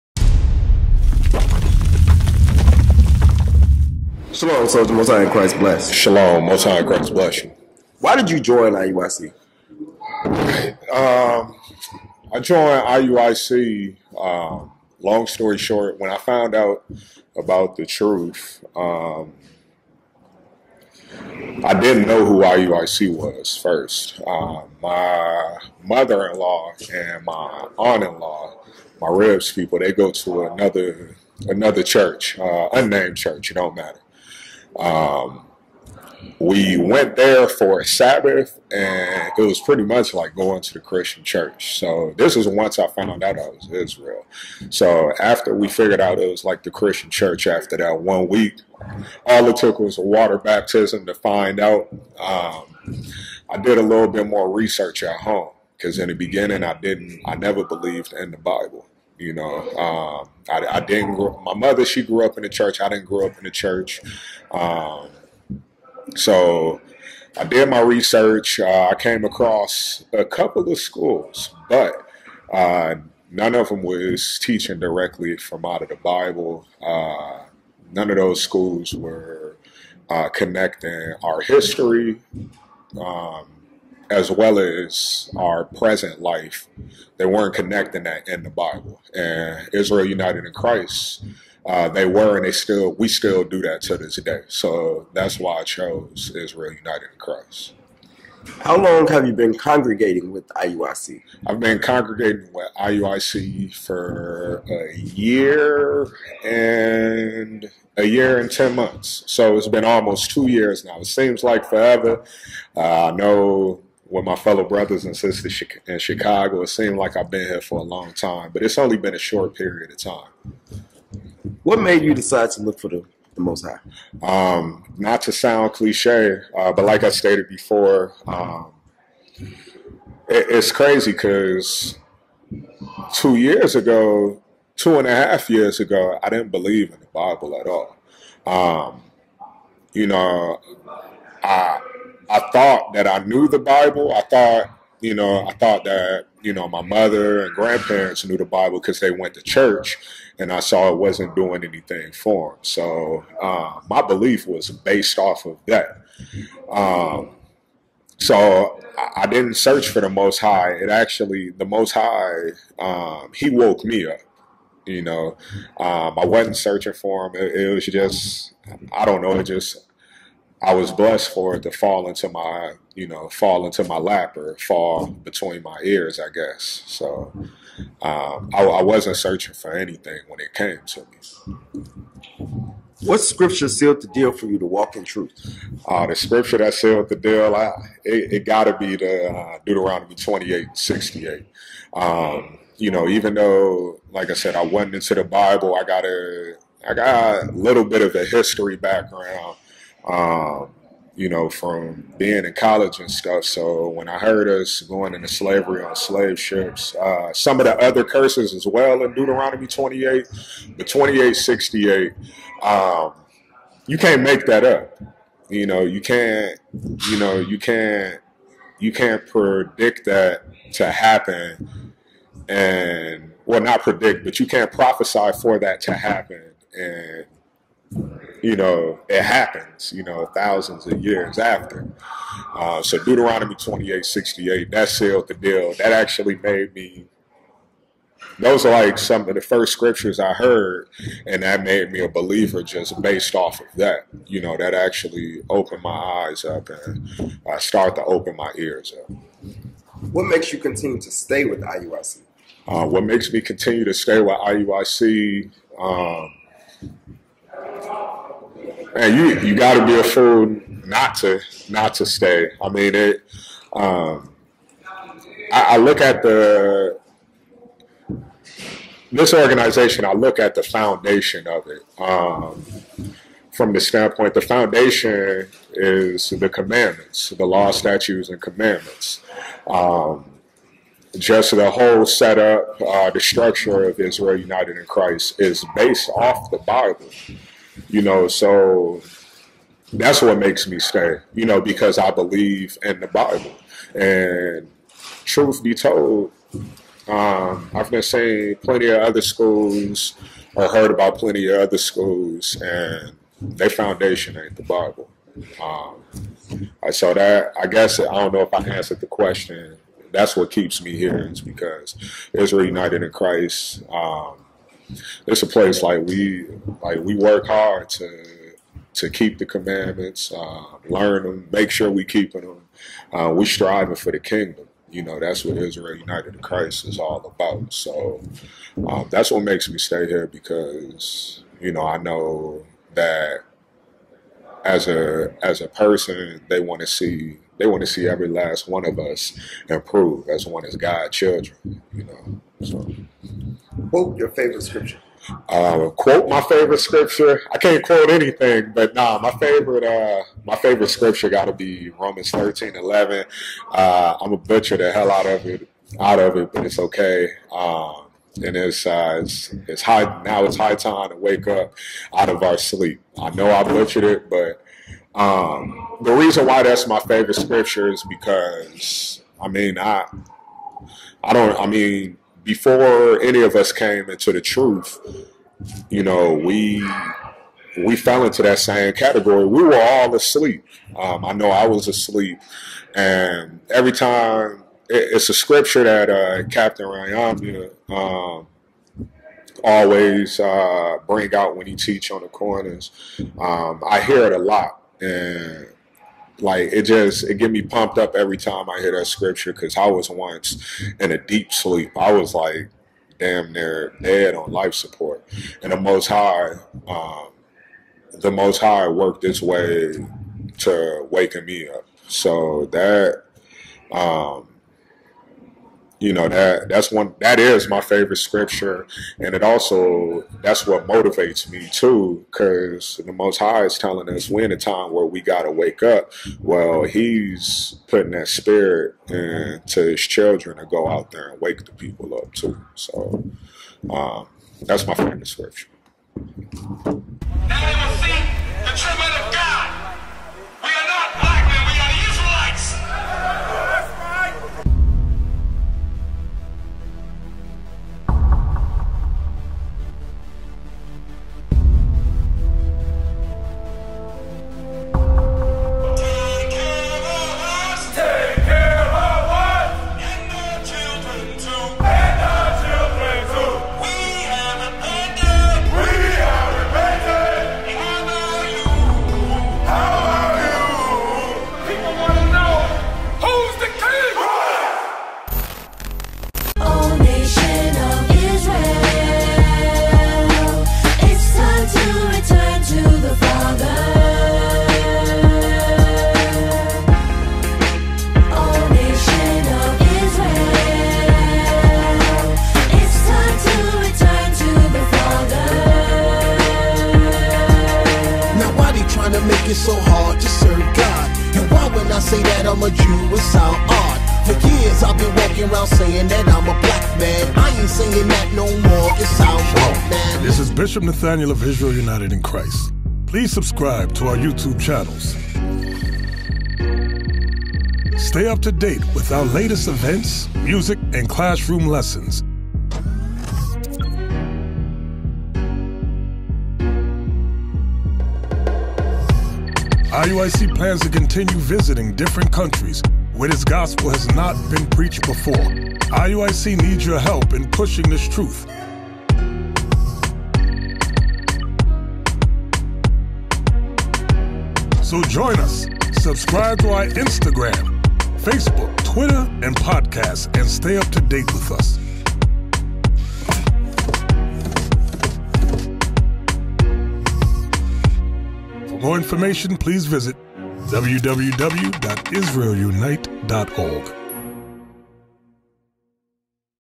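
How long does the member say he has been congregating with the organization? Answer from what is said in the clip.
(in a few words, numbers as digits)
1 year and 10 months.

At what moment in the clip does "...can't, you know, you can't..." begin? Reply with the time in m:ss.
3:35.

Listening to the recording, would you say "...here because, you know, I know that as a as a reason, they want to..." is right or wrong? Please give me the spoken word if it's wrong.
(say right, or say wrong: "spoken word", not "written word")
wrong: "person", not "reason".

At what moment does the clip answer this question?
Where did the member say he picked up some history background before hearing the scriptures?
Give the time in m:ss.
3:22.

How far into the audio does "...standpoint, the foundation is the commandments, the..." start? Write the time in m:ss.
4:33.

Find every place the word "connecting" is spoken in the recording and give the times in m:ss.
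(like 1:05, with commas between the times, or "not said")
1:20, 1:27.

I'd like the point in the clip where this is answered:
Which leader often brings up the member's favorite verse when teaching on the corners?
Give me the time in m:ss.
6:26.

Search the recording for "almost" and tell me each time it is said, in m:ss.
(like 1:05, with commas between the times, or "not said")
1:49.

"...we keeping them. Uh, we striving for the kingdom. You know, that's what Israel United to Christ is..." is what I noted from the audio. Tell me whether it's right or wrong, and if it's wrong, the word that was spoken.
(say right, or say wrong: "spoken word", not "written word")
right.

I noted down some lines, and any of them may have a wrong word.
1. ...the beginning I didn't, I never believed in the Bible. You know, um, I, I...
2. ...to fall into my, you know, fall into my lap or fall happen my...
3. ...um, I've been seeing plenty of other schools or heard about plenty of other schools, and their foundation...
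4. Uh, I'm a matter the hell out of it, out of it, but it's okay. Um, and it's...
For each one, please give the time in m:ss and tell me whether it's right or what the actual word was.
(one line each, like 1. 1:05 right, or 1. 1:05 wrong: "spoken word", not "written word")
1. 0:56 right
2. 2:51 wrong: "between", not "happen"
3. 4:57 right
4. 5:53 wrong: "butcher", not "matter".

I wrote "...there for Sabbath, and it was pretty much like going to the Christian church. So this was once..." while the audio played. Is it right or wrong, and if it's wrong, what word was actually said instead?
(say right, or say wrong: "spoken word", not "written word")
right.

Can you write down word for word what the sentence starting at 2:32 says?
So uh, my belief was based off of that.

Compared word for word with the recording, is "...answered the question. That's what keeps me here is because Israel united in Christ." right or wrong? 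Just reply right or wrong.
right.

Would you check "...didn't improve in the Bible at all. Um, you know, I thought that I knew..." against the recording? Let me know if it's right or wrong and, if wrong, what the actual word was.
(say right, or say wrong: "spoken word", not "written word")
wrong: "believe", not "improve".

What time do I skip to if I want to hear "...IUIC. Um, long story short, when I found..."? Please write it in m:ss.
0:12.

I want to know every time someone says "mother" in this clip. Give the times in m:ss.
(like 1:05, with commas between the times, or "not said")
0:25, 1:01, 2:26.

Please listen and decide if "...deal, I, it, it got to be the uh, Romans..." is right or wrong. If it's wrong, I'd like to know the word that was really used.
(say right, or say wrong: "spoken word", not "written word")
wrong: "Deuteronomy", not "Romans".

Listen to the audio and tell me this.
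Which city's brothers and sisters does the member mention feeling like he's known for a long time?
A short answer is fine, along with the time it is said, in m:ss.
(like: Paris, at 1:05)
Chicago, at 1:55.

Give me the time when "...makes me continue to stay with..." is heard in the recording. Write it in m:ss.
4:13.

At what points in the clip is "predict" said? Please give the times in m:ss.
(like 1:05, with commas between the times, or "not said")
3:39, 3:43.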